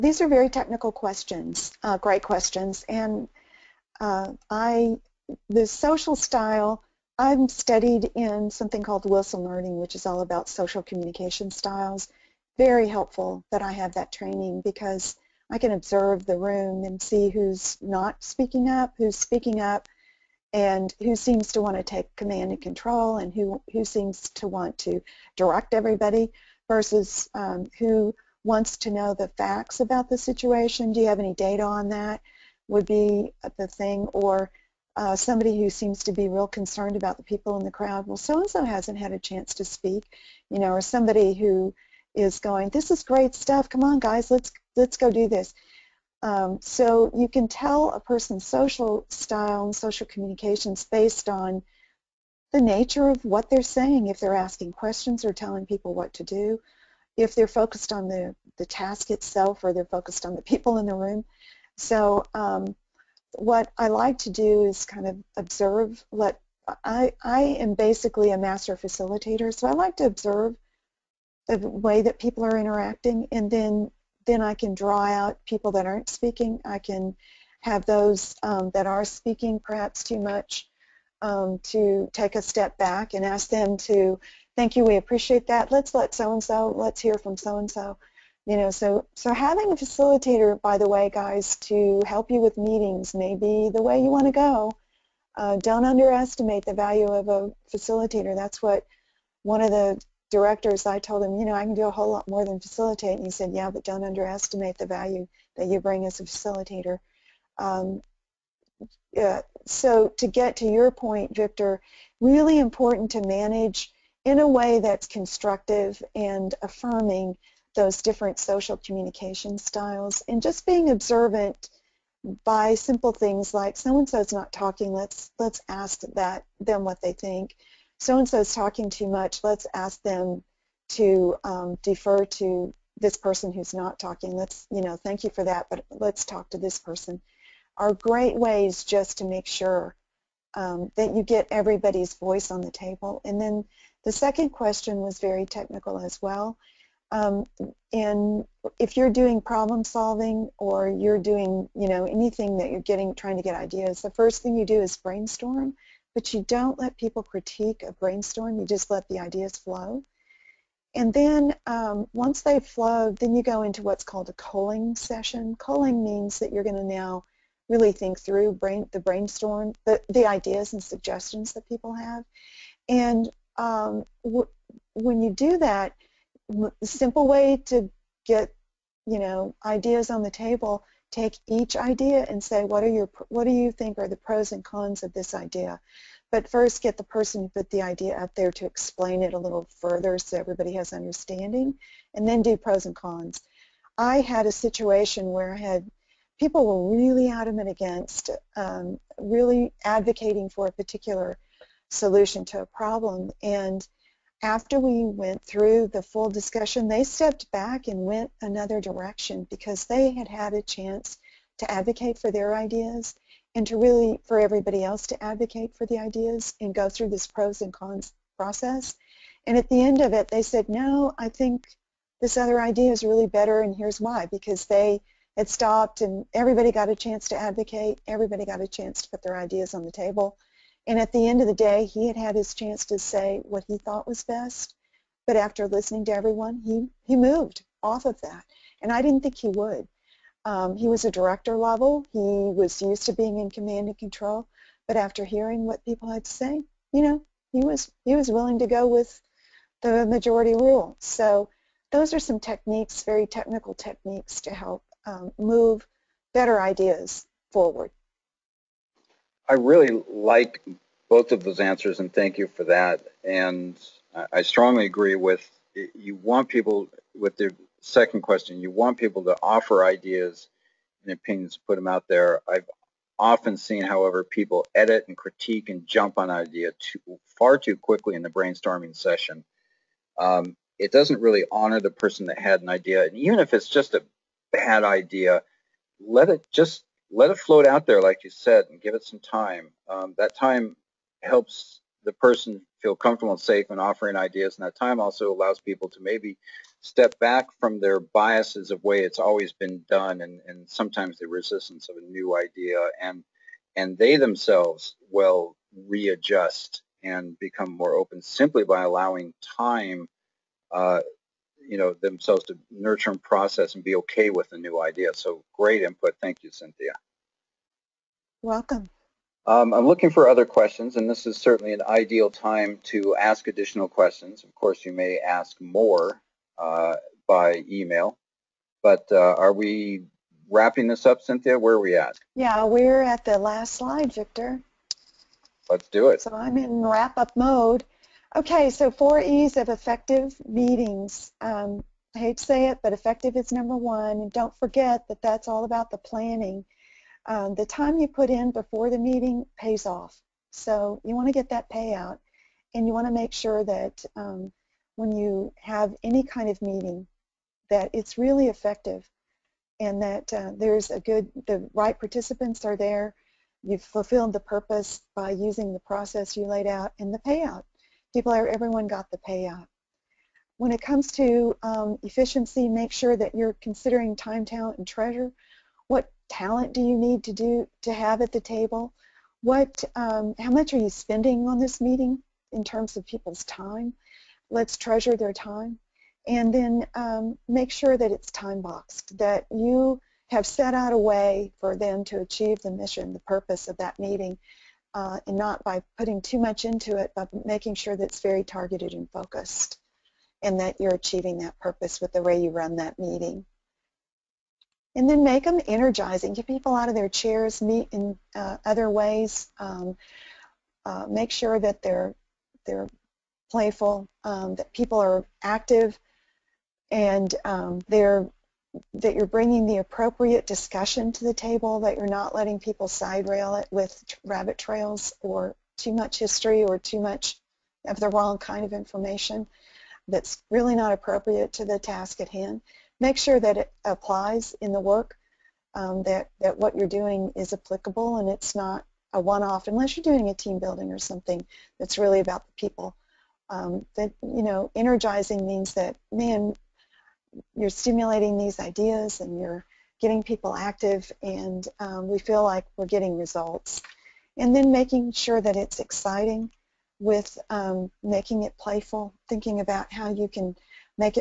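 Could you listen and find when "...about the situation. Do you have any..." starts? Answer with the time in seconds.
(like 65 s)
29 s.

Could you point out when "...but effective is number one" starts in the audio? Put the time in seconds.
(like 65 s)
342 s.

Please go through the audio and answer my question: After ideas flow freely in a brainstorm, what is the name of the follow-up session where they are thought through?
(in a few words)
culling session.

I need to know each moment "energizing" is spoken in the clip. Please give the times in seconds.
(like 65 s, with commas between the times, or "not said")
405 s, 444 s.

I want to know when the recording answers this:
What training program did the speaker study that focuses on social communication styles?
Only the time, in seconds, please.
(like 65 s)
9 s.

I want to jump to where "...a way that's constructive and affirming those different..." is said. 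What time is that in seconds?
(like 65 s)
114 s.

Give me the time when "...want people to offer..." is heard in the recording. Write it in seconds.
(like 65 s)
268 s.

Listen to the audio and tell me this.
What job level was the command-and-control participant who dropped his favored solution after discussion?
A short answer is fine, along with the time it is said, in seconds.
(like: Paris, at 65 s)
director level, at 241 s.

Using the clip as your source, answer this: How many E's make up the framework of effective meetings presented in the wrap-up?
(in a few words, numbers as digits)
4.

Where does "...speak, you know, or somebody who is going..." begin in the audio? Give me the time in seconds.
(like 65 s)
39 s.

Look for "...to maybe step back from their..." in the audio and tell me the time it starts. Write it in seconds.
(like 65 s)
295 s.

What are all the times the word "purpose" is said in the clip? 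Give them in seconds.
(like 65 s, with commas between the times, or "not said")
364 s, 393 s, 401 s.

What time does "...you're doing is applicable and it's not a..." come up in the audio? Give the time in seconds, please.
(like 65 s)
436 s.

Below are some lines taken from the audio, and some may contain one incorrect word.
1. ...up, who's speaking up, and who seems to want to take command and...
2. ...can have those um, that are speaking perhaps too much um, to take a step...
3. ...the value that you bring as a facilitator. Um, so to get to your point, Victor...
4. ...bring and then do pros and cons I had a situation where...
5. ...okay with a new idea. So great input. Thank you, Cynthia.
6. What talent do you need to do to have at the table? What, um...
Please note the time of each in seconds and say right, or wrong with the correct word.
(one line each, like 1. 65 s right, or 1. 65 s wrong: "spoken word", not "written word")
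1. 18 s right
2. 76 s right
3. 104 s right
4. 190 s wrong: "understanding", not "bring"
5. 313 s right
6. 375 s right.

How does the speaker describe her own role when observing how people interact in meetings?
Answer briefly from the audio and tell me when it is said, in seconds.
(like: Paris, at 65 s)
master facilitator, at 68 s.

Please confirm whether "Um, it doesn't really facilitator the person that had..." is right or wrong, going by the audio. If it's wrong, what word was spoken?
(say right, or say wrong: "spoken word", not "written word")
wrong: "honor", not "facilitator".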